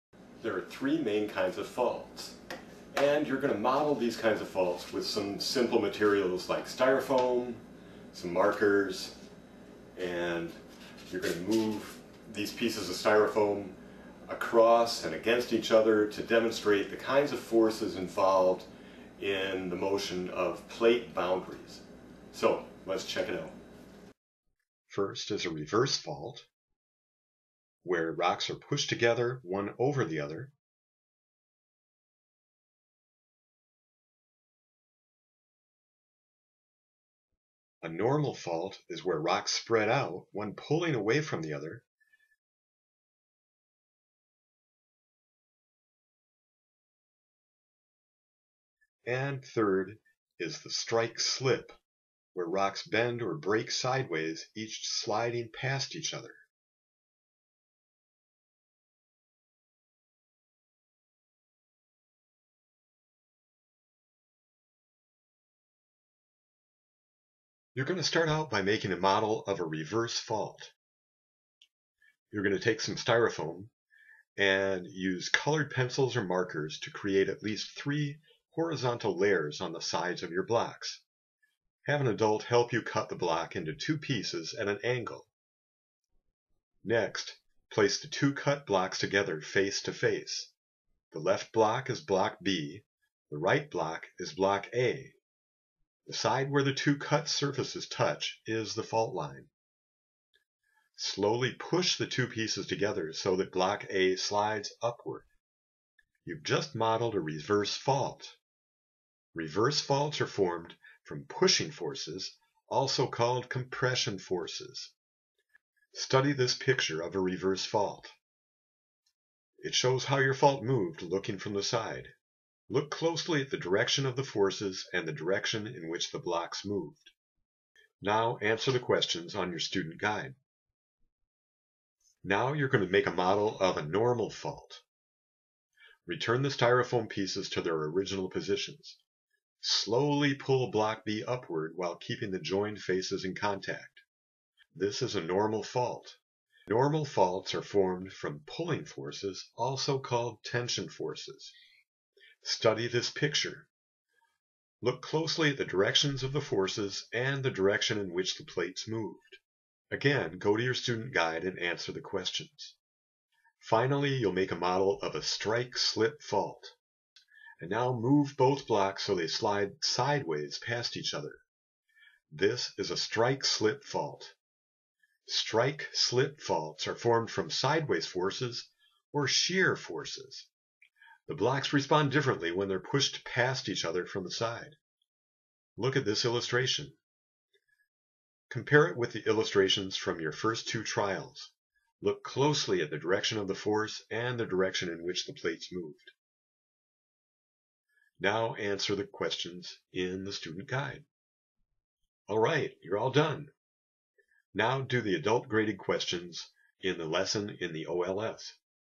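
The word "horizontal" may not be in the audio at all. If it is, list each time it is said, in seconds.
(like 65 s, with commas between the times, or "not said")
78 s.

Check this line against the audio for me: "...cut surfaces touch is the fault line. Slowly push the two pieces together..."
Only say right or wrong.
right.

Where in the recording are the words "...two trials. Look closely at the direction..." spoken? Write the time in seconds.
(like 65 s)
190 s.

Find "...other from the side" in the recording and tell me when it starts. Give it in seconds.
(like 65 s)
183 s.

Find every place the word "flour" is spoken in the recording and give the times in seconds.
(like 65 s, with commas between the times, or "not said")
not said.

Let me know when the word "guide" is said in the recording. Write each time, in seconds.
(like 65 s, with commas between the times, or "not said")
129 s, 161 s, 200 s.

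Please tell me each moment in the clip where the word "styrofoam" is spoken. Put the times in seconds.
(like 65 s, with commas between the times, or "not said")
6 s, 12 s, 72 s, 136 s.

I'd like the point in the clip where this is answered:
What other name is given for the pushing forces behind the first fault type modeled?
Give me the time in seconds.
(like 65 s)
113 s.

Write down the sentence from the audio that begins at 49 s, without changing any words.
And third is the strike slip, where rocks bend or break sideways, each sliding past each other.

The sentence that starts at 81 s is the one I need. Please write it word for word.
Have an adult help you cut the block into two pieces at an angle.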